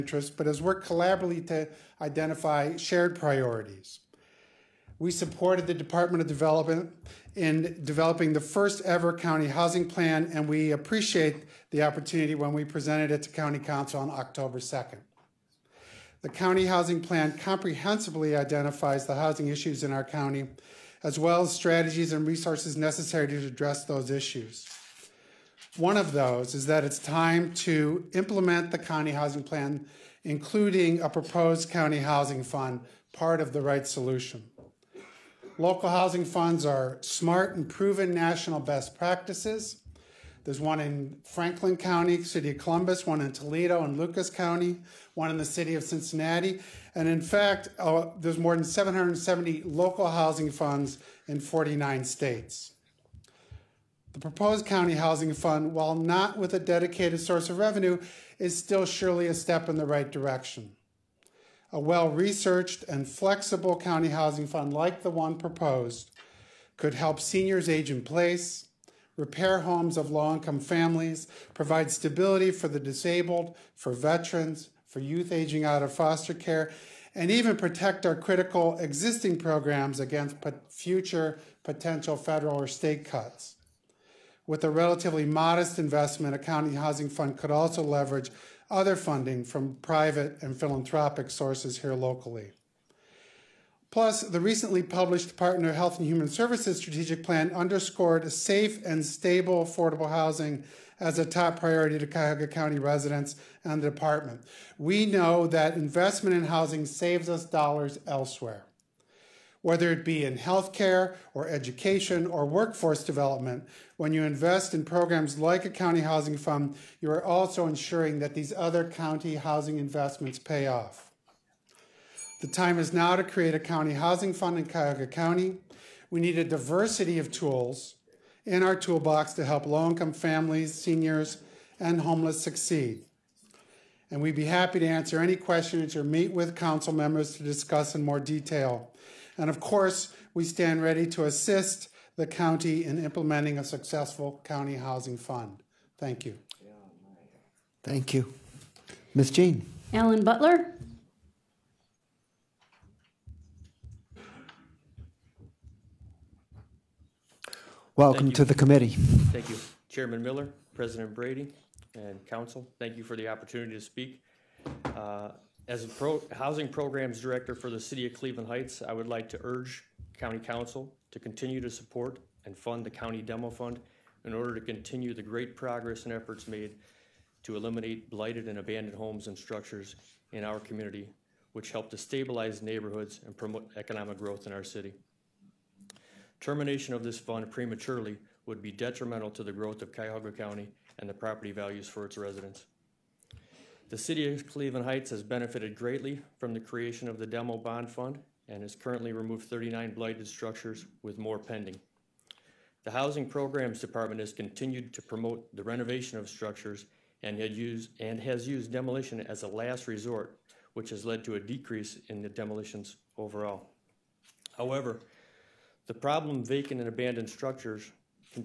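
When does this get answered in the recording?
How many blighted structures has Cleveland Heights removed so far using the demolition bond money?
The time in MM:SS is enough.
03:19.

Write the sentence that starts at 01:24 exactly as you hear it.
With a relatively modest investment, a county housing fund could also leverage other funding from private and philanthropic sources here locally.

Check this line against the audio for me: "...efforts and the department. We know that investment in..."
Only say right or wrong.
wrong.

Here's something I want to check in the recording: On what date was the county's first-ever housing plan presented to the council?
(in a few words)
October 2.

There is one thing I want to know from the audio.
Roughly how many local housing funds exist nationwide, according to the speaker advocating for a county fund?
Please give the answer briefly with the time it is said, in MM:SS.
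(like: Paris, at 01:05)
More than 770, at 00:48.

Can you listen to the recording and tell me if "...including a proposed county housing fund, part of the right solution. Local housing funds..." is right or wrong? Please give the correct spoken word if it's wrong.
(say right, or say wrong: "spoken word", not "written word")
right.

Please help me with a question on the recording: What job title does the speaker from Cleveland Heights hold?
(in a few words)
Housing Programs Director.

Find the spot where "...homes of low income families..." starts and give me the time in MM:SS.
01:09.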